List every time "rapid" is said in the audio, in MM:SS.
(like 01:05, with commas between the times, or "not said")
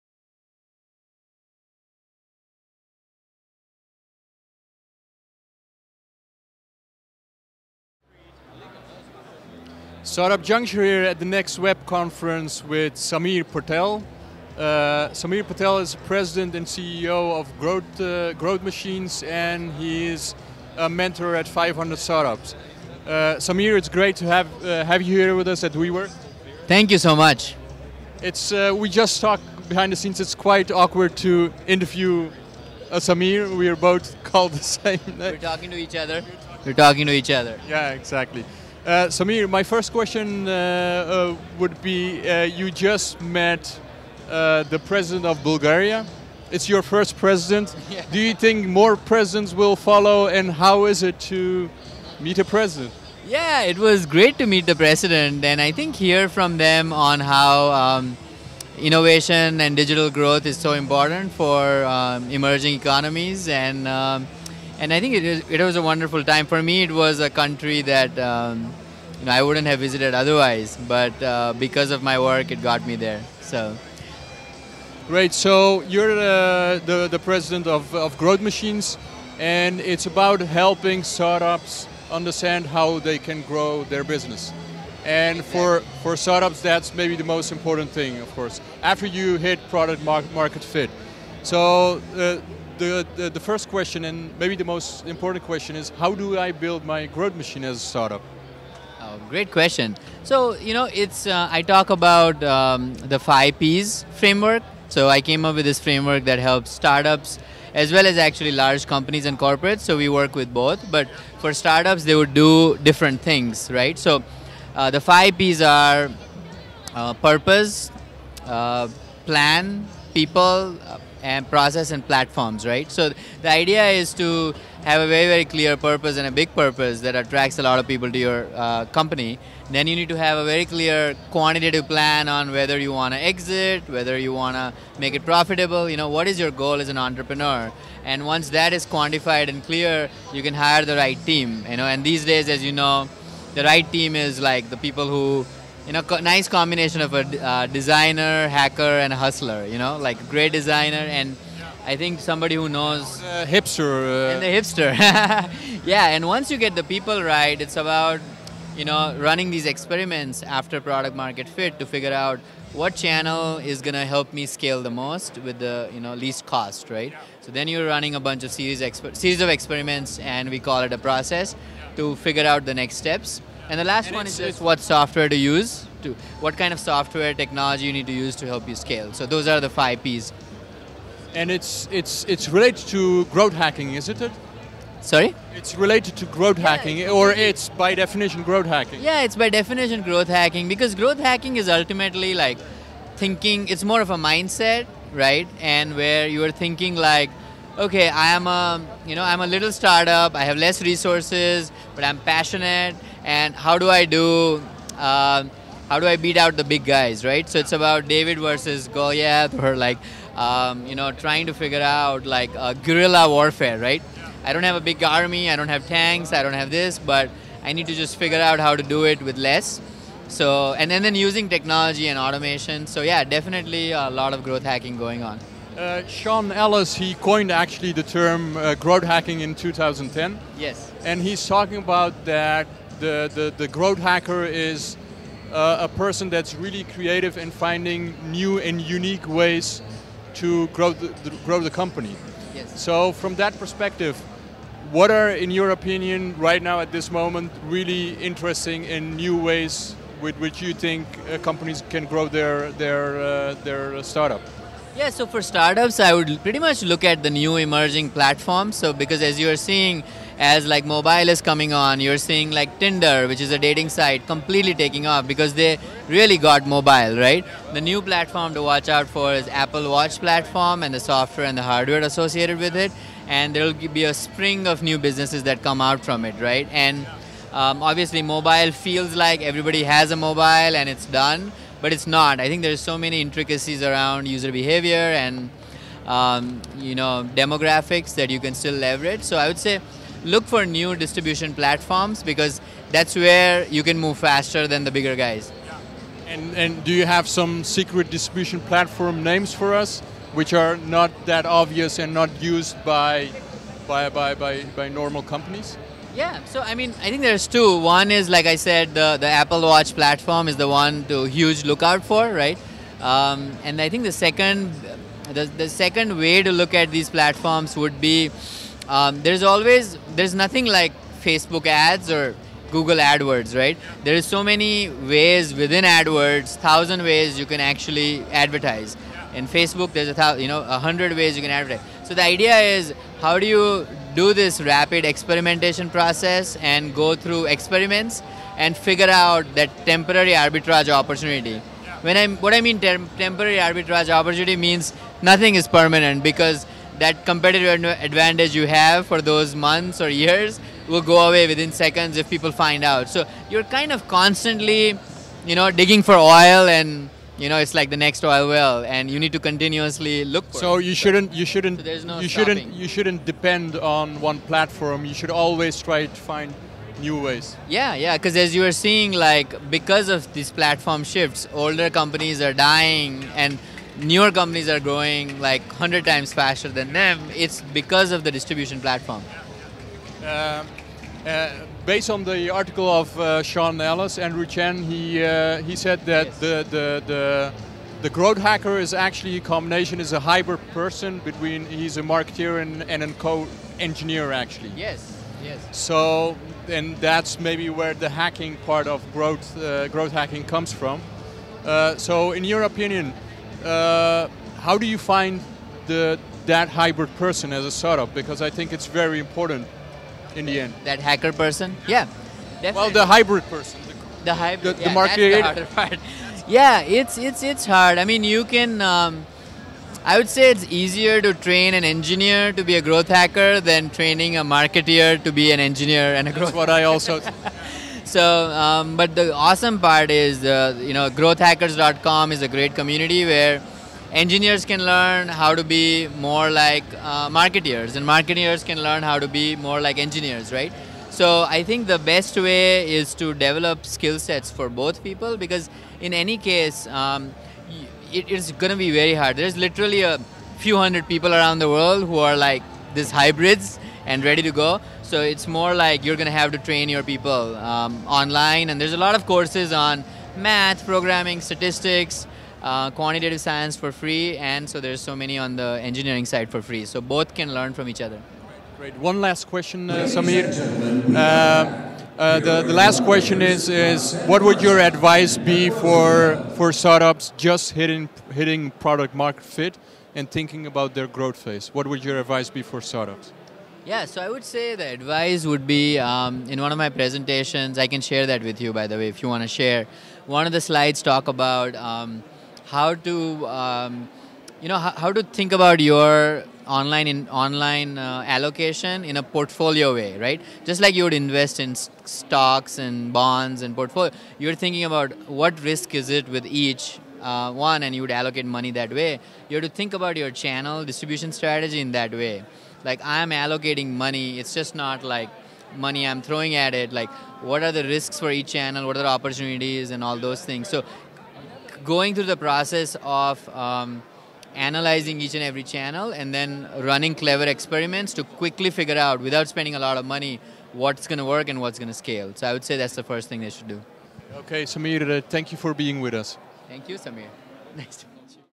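05:34.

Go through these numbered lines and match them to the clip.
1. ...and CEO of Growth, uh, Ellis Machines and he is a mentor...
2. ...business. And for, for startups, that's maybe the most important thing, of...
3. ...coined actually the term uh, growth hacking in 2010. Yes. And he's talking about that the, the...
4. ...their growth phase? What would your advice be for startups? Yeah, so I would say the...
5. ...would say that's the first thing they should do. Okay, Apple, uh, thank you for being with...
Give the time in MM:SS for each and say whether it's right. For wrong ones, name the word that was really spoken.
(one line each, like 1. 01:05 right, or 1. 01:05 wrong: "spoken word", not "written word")
1. 00:16 wrong: "Growth", not "Ellis"
2. 01:24 right
3. 03:47 right
4. 08:00 right
5. 08:52 wrong: "Samir", not "Apple".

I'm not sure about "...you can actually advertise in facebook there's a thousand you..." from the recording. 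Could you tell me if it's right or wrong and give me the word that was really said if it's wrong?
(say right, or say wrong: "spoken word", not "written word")
right.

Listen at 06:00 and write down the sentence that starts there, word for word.
you shouldn't you shouldn't so no you stopping.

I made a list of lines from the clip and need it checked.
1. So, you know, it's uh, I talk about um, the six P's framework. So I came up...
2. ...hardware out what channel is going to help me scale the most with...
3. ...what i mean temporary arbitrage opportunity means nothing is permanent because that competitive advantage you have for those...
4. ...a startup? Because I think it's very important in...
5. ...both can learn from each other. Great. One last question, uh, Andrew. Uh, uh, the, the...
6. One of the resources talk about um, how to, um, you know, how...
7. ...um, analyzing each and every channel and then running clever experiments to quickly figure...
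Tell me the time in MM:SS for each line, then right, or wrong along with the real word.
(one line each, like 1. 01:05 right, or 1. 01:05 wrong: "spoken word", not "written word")
1. 01:40 wrong: "five", not "six"
2. 02:41 wrong: "figure", not "hardware"
3. 05:42 right
4. 06:47 right
5. 07:46 wrong: "Samir", not "Andrew"
6. 08:10 wrong: "slides", not "resources"
7. 08:43 right.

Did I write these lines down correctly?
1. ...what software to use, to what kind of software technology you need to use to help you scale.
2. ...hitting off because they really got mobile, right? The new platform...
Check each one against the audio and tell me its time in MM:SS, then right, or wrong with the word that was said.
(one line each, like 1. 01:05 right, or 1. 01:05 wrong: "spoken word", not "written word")
1. 02:54 right
2. 04:24 wrong: "taking", not "hitting".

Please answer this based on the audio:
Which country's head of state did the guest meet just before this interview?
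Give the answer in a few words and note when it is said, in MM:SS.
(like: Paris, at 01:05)
Bulgaria, at 00:45.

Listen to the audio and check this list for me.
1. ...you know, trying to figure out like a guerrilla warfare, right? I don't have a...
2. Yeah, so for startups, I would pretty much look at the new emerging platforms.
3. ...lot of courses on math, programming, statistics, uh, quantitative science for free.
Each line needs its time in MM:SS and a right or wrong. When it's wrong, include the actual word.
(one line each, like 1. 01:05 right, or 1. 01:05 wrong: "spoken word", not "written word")
1. 03:30 right
2. 04:14 right
3. 07:39 right.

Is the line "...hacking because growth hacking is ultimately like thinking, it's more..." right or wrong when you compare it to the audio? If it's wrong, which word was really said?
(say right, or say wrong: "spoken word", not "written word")
right.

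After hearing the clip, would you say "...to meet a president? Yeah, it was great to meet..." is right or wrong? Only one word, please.
right.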